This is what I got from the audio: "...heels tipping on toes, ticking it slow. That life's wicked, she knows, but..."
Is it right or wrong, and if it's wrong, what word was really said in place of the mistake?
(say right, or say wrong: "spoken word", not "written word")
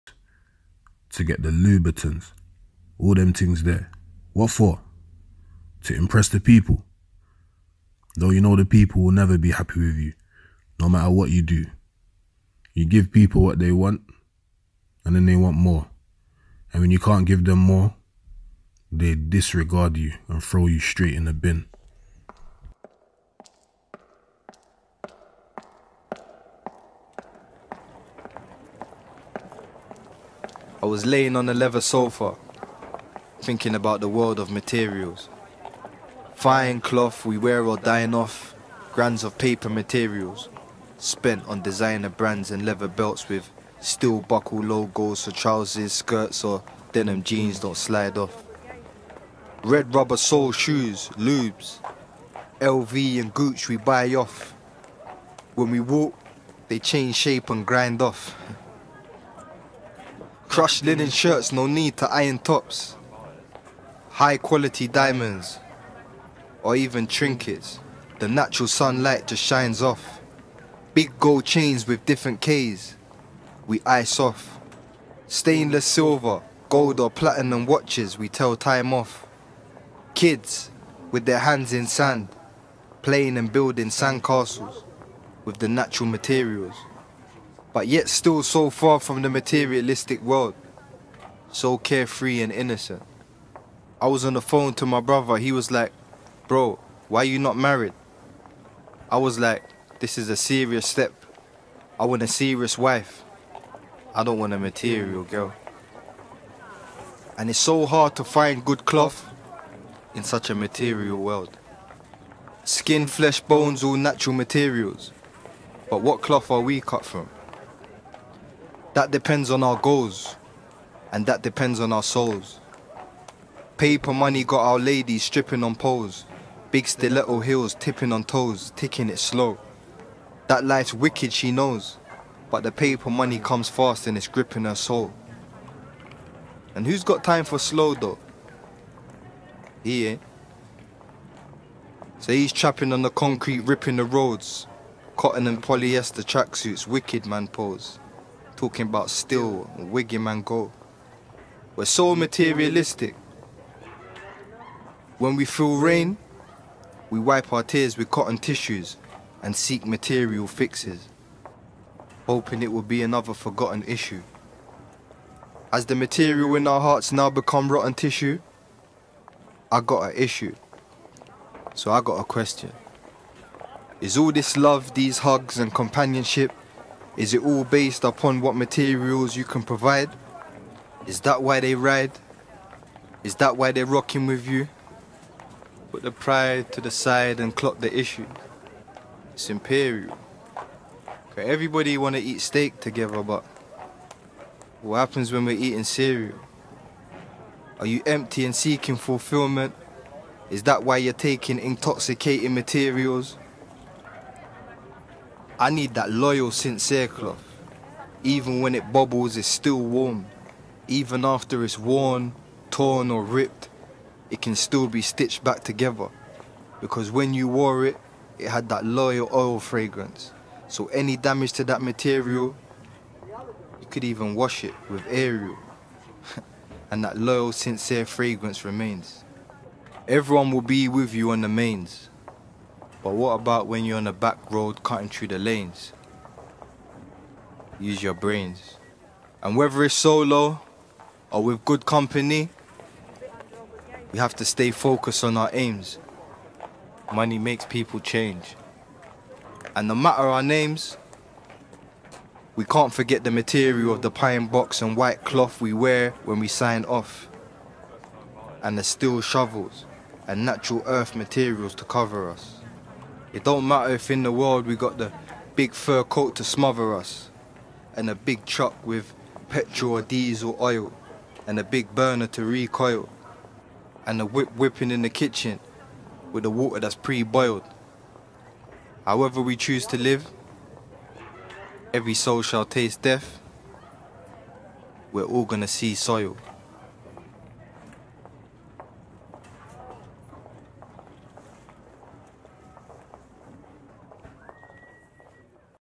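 right.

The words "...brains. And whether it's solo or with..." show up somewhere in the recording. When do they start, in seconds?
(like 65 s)
238 s.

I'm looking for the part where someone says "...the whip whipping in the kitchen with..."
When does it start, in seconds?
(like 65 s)
274 s.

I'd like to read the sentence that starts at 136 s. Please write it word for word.
And who's got time for slow though?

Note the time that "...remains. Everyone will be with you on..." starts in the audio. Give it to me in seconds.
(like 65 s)
228 s.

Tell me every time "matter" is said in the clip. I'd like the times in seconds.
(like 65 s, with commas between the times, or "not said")
10 s, 249 s, 263 s.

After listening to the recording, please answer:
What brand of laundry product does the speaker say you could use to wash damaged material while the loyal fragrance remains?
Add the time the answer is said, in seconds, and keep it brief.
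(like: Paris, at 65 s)
Ariel, at 225 s.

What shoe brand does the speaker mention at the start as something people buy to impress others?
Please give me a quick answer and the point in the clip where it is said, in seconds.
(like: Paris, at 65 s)
Louboutins, at 1 s.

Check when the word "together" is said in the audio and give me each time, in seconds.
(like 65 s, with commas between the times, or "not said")
192 s, 215 s.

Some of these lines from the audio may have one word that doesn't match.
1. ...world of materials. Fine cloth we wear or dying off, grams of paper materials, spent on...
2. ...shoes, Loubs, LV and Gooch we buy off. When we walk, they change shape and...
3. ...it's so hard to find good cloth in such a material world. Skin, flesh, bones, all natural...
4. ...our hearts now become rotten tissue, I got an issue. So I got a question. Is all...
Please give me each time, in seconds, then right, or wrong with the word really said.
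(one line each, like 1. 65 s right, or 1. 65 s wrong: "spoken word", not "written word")
1. 34 s right
2. 50 s right
3. 107 s right
4. 166 s right.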